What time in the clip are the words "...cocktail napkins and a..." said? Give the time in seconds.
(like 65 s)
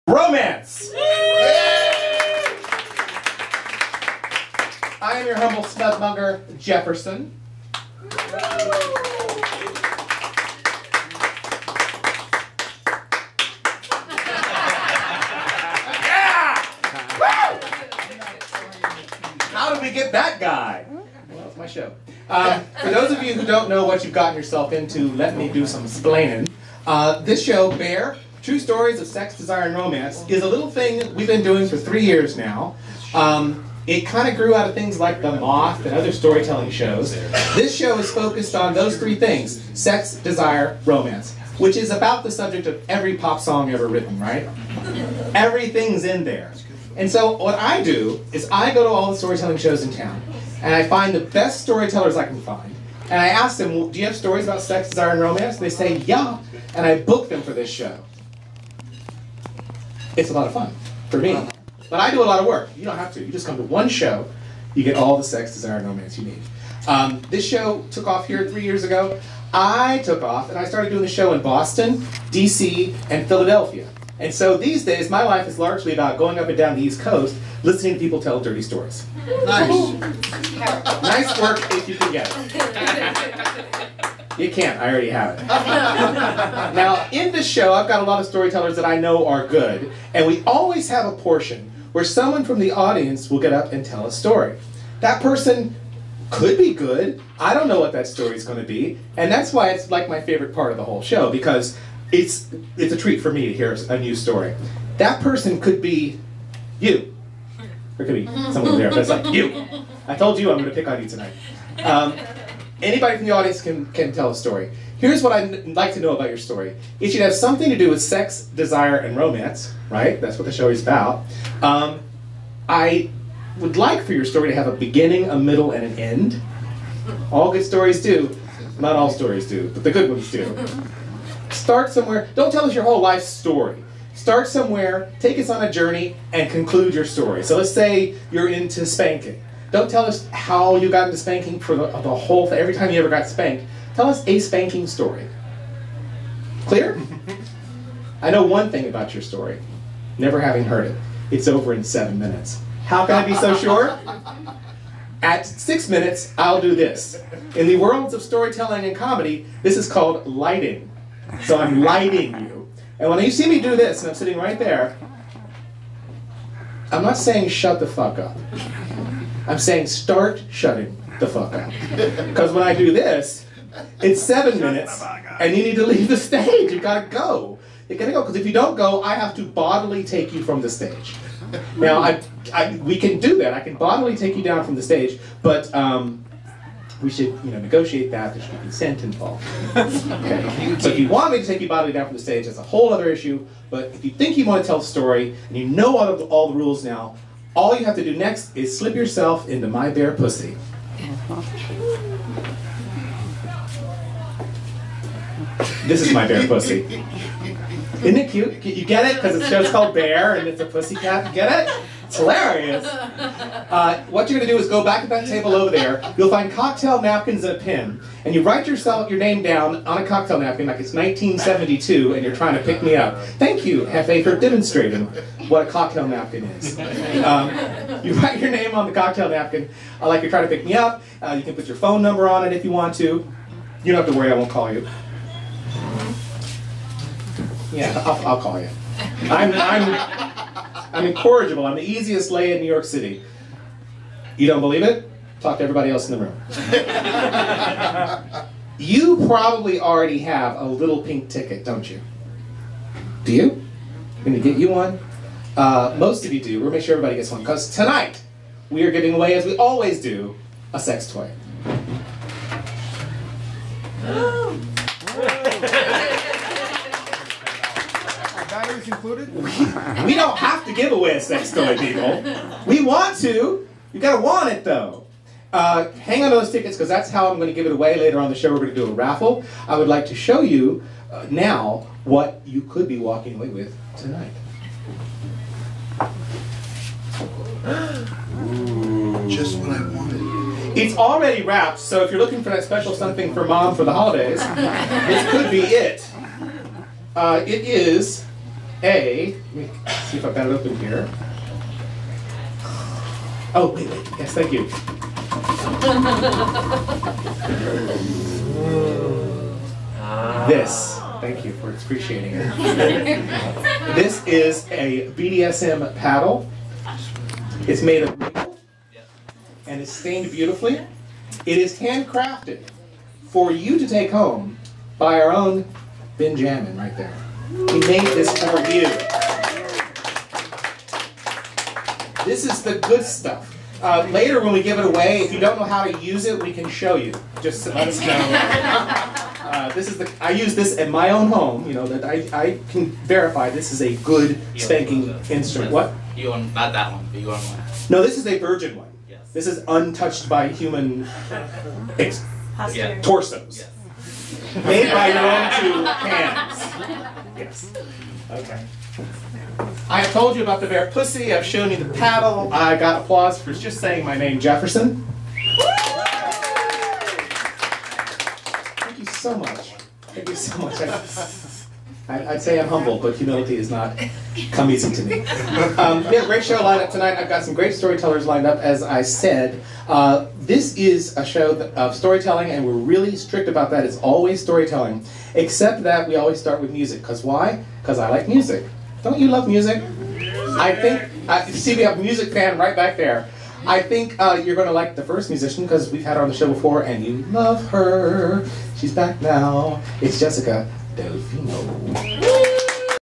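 216 s.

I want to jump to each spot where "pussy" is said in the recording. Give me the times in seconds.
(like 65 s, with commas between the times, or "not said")
200 s, 206 s, 210 s, 360 s.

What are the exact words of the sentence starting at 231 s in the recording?
Uh, you can put your phone number on it if you want to.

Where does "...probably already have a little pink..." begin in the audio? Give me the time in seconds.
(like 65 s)
249 s.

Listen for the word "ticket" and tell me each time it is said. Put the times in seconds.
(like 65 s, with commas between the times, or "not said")
251 s, 276 s.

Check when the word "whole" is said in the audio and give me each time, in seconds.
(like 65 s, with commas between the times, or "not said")
100 s, 132 s, 142 s, 192 s.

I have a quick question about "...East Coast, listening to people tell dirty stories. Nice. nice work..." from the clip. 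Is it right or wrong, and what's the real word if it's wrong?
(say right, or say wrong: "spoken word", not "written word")
right.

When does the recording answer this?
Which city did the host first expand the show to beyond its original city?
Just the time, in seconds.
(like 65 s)
71 s.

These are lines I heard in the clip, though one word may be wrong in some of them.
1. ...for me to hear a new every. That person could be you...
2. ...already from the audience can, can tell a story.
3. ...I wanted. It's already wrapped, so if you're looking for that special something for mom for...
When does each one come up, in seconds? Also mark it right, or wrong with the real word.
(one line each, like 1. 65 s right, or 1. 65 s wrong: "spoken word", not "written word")
1. 103 s wrong: "story", not "every"
2. 112 s wrong: "anybody", not "already"
3. 289 s right.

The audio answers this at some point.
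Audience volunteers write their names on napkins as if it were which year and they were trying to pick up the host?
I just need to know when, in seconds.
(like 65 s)
220 s.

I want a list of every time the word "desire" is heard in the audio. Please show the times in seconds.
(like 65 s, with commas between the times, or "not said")
29 s, 40 s, 54 s, 65 s, 118 s.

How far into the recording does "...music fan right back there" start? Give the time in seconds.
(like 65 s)
392 s.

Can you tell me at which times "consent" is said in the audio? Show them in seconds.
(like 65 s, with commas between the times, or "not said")
188 s.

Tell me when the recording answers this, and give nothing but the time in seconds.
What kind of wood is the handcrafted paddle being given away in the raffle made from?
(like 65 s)
318 s.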